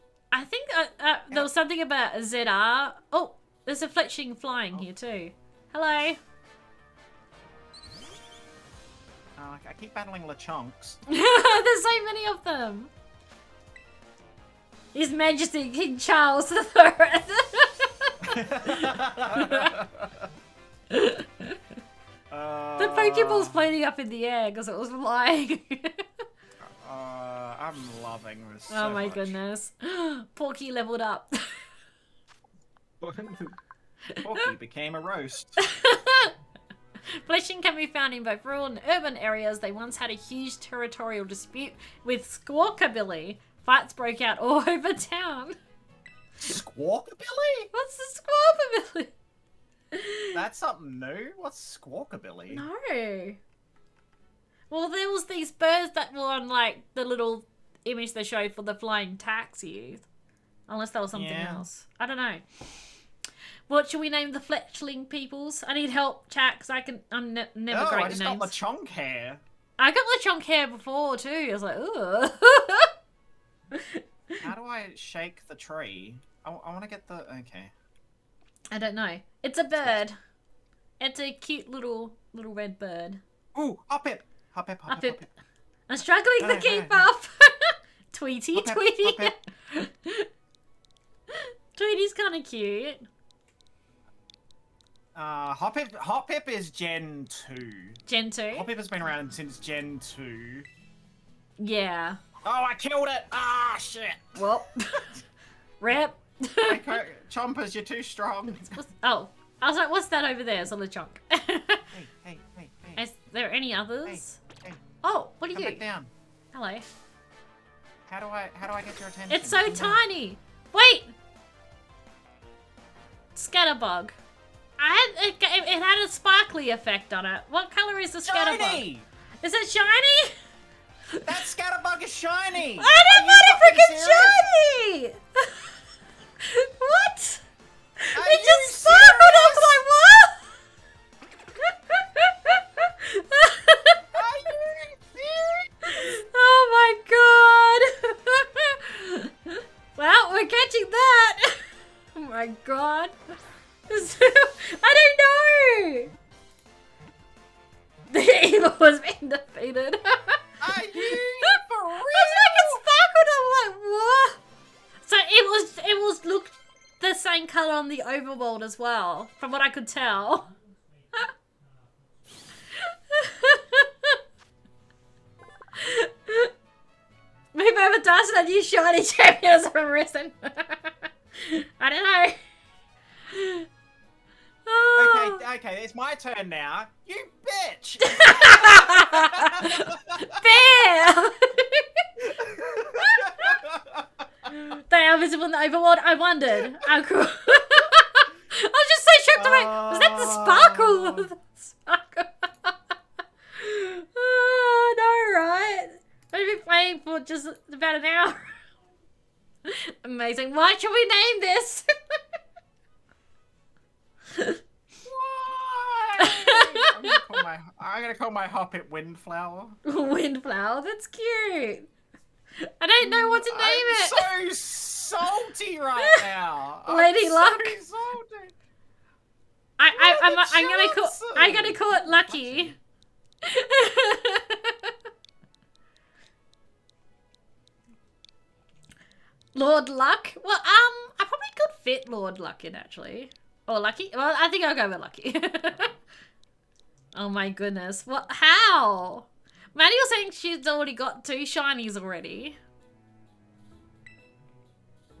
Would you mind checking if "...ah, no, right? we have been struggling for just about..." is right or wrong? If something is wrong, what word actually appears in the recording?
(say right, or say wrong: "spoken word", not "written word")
wrong: "playing", not "struggling".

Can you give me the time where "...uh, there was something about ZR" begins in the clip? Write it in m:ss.
0:00.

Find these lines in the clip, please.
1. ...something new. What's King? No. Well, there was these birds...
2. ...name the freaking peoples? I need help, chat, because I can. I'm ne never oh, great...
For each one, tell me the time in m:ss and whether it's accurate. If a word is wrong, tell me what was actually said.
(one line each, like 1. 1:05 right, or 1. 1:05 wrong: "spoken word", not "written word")
1. 0:50 wrong: "Squawkabilly", not "King"
2. 1:04 wrong: "fletchling", not "freaking".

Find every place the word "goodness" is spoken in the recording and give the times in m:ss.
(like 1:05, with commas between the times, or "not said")
0:29, 4:07.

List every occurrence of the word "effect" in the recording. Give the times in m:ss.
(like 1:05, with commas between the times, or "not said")
2:06.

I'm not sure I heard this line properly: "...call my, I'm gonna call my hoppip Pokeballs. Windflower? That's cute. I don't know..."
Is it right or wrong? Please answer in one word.
wrong.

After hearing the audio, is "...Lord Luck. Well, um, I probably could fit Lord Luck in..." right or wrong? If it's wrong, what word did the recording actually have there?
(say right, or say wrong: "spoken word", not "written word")
right.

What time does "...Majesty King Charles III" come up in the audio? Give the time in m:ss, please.
0:15.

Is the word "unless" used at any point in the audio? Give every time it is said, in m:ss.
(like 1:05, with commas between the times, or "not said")
1:00.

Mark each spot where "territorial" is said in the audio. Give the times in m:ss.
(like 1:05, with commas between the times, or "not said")
0:40.